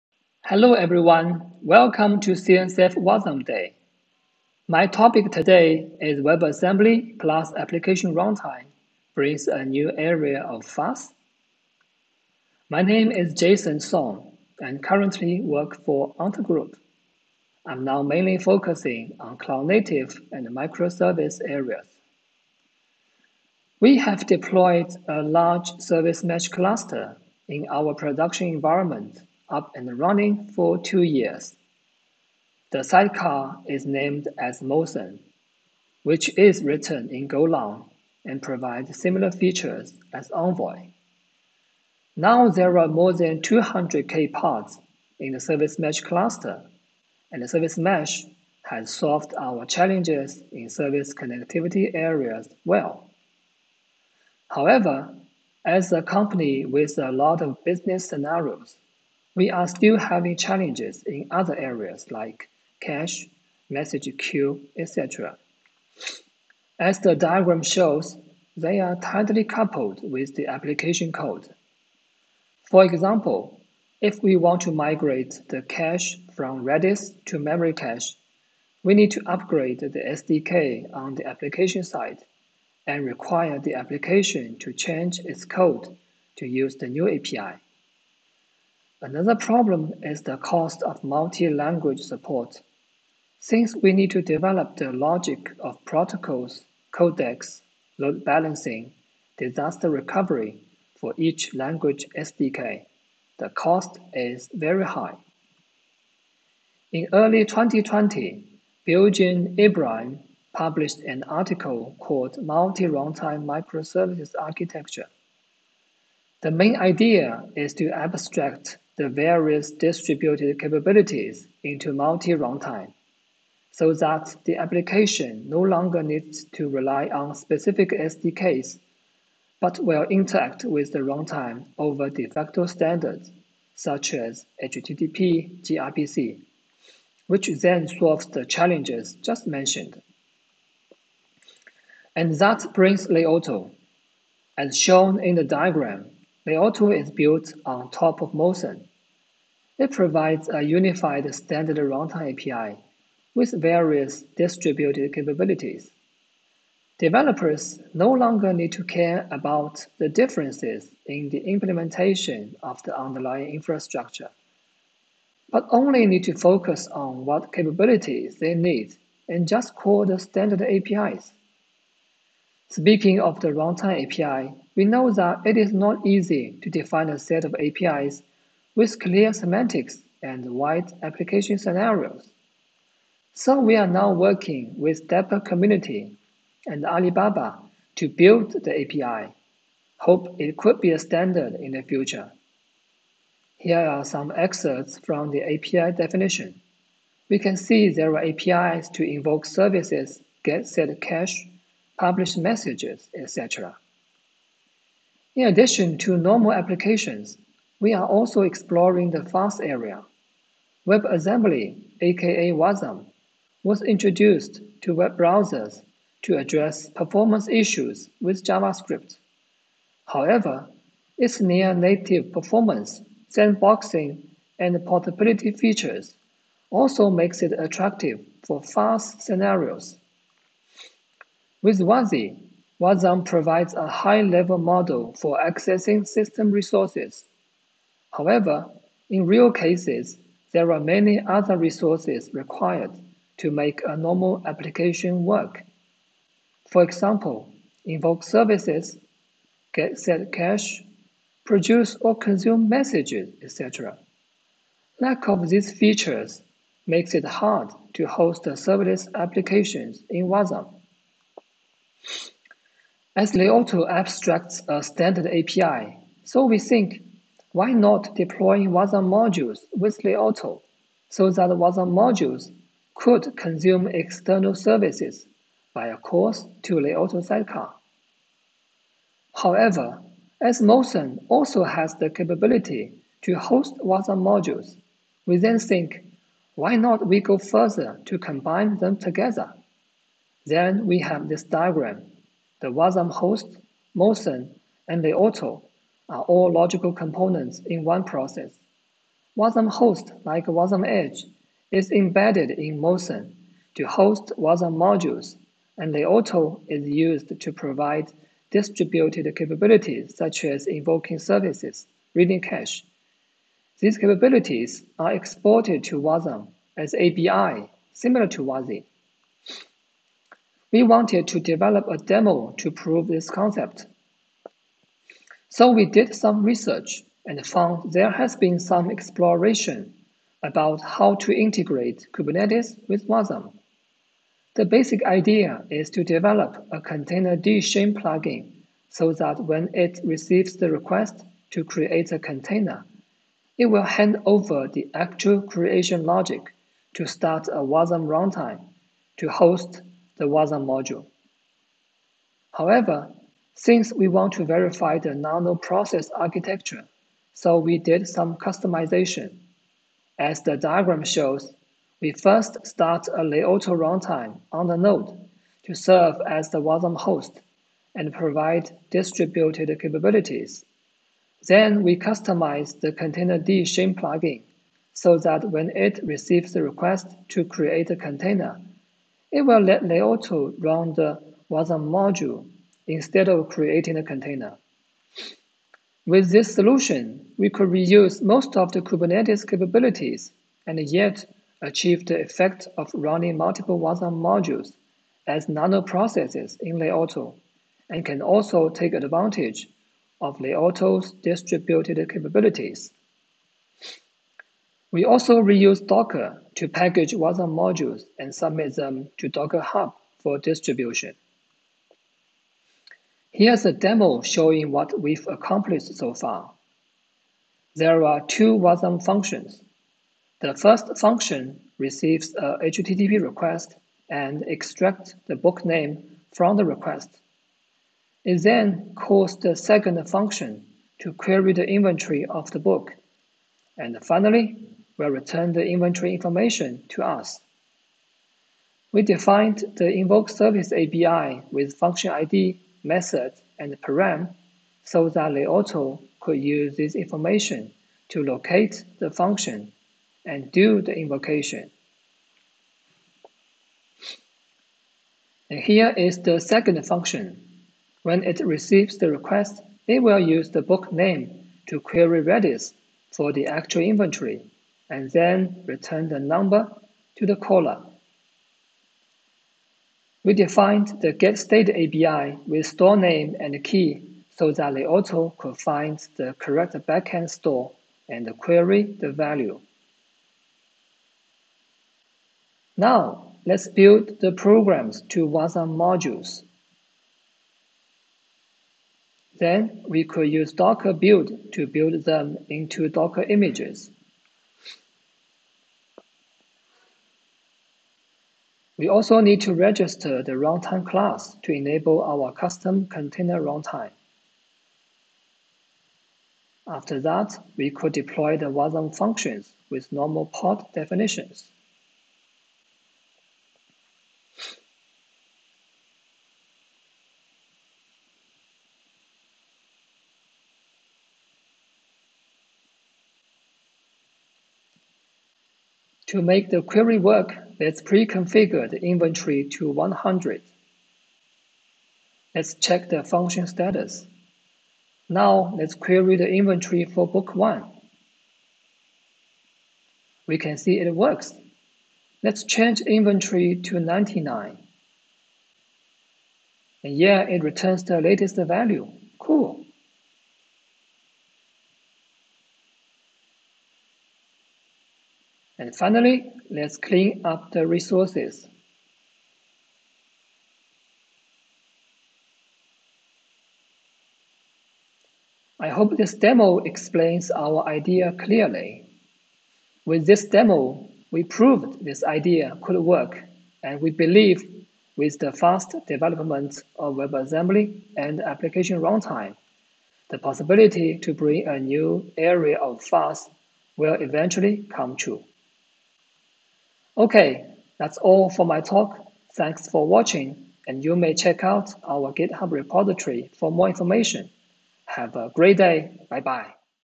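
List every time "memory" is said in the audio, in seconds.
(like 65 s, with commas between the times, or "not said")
77 s.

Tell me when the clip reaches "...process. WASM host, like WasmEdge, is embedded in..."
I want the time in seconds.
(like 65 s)
298 s.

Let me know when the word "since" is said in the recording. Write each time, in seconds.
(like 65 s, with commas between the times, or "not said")
93 s, 353 s.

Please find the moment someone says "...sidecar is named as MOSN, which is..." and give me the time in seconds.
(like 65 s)
32 s.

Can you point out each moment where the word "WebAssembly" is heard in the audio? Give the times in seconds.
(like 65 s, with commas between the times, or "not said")
6 s, 210 s, 576 s.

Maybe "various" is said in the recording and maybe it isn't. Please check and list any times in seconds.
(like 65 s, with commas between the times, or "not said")
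119 s, 153 s.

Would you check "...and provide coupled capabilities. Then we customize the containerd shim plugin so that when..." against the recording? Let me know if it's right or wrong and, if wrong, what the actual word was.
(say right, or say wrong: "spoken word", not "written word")
wrong: "distributed", not "coupled".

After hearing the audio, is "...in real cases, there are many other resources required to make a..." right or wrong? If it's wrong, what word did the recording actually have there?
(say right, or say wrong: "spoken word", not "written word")
right.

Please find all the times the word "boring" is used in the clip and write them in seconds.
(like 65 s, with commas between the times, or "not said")
not said.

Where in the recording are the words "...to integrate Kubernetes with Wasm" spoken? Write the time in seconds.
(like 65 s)
331 s.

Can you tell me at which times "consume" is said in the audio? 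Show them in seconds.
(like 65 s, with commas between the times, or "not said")
252 s, 273 s.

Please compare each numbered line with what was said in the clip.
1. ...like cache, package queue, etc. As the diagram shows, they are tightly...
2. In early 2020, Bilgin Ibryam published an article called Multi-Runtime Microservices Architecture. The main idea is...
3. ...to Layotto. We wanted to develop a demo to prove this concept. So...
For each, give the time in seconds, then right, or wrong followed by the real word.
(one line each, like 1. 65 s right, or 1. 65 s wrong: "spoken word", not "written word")
1. 62 s wrong: "message", not "package"
2. 106 s right
3. 318 s wrong: "WASI", not "Layotto".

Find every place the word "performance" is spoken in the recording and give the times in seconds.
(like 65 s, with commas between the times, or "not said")
216 s, 222 s.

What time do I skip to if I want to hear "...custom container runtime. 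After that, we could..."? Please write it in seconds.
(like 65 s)
502 s.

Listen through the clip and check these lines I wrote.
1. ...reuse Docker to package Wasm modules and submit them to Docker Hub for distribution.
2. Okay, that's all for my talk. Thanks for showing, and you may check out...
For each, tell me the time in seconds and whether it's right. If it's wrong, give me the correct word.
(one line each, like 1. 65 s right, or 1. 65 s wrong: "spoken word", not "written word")
1. 405 s right
2. 586 s wrong: "watching", not "showing".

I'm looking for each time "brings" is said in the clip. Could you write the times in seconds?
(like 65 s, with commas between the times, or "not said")
9 s, 142 s, 581 s.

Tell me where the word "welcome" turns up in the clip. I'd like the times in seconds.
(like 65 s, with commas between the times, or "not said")
1 s.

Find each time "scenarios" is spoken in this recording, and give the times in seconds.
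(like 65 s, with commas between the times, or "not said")
58 s, 181 s, 229 s.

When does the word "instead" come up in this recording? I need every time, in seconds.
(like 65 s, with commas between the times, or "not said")
382 s.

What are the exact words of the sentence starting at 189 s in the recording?
Hope it could be a standard in the future.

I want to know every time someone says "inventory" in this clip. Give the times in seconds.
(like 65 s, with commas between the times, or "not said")
431 s, 435 s, 463 s, 528 s, 536 s, 542 s.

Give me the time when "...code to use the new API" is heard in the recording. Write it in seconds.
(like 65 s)
85 s.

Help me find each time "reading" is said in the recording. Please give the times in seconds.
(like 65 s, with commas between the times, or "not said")
312 s.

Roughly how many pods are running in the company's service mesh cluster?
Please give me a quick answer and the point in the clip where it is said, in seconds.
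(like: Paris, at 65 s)
200k, at 43 s.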